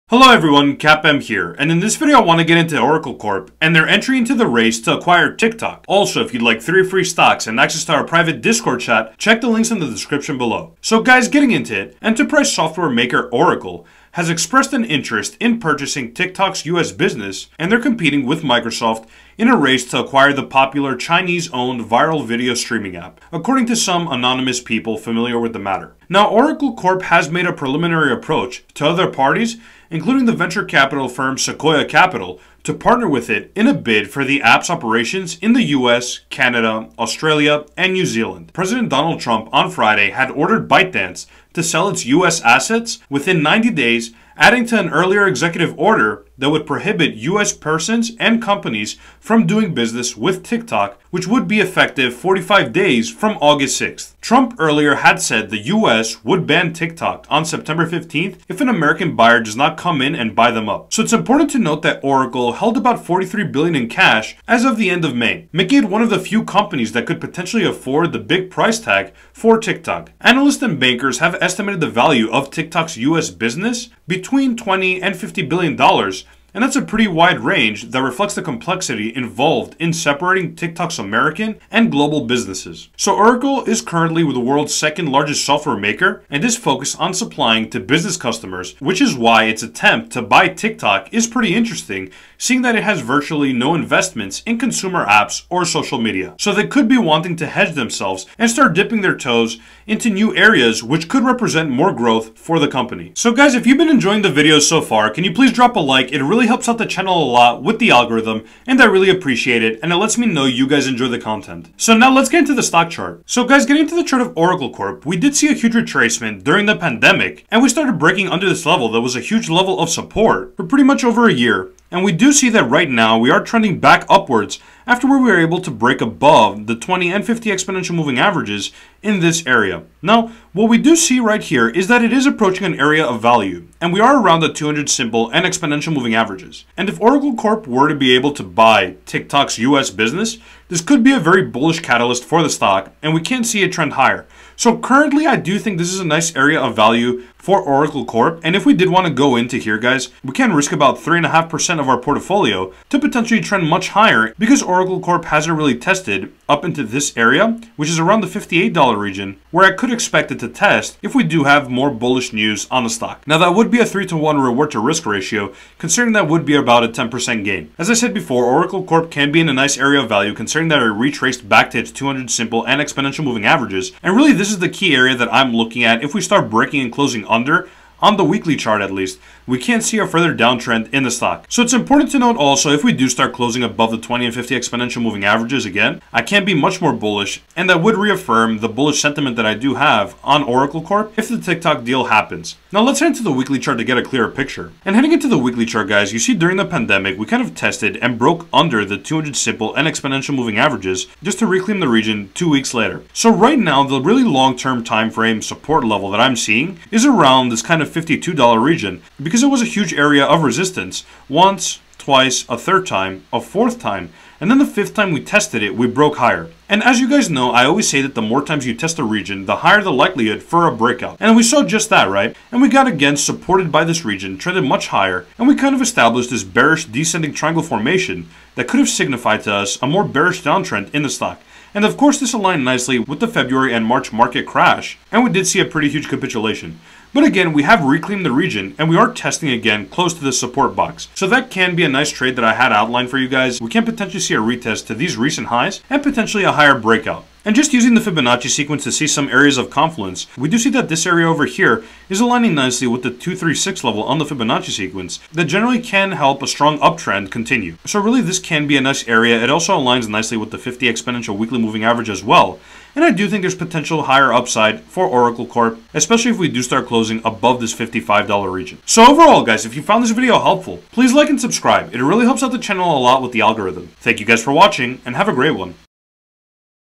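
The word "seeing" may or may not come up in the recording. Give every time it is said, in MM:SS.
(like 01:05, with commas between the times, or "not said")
01:32, 03:26.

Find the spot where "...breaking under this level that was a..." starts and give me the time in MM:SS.
01:57.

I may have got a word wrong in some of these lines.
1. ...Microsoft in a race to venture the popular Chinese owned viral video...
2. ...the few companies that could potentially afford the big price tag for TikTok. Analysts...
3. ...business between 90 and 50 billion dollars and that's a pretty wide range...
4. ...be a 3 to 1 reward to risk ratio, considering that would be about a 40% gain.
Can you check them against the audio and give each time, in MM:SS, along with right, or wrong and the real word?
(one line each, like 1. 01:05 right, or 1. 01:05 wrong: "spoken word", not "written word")
1. 00:18 wrong: "acquire", not "venture"
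2. 01:06 right
3. 01:13 wrong: "20", not "90"
4. 02:43 wrong: "10", not "40".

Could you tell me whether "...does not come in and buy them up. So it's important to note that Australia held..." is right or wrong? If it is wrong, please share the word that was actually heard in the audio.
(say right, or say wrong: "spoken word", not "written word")
wrong: "Oracle", not "Australia".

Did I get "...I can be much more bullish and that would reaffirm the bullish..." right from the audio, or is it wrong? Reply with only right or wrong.
right.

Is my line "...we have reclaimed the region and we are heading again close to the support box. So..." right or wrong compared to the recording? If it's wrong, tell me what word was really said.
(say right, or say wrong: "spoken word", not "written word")
wrong: "testing", not "heading".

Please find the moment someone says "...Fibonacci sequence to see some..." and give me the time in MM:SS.
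04:08.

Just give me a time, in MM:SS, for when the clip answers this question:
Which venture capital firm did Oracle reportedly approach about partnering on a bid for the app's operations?
00:31.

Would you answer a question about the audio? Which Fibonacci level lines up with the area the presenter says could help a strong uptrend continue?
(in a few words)
236.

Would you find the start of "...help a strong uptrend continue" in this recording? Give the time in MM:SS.
04:16.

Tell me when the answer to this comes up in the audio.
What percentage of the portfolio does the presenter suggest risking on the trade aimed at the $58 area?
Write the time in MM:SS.
02:30.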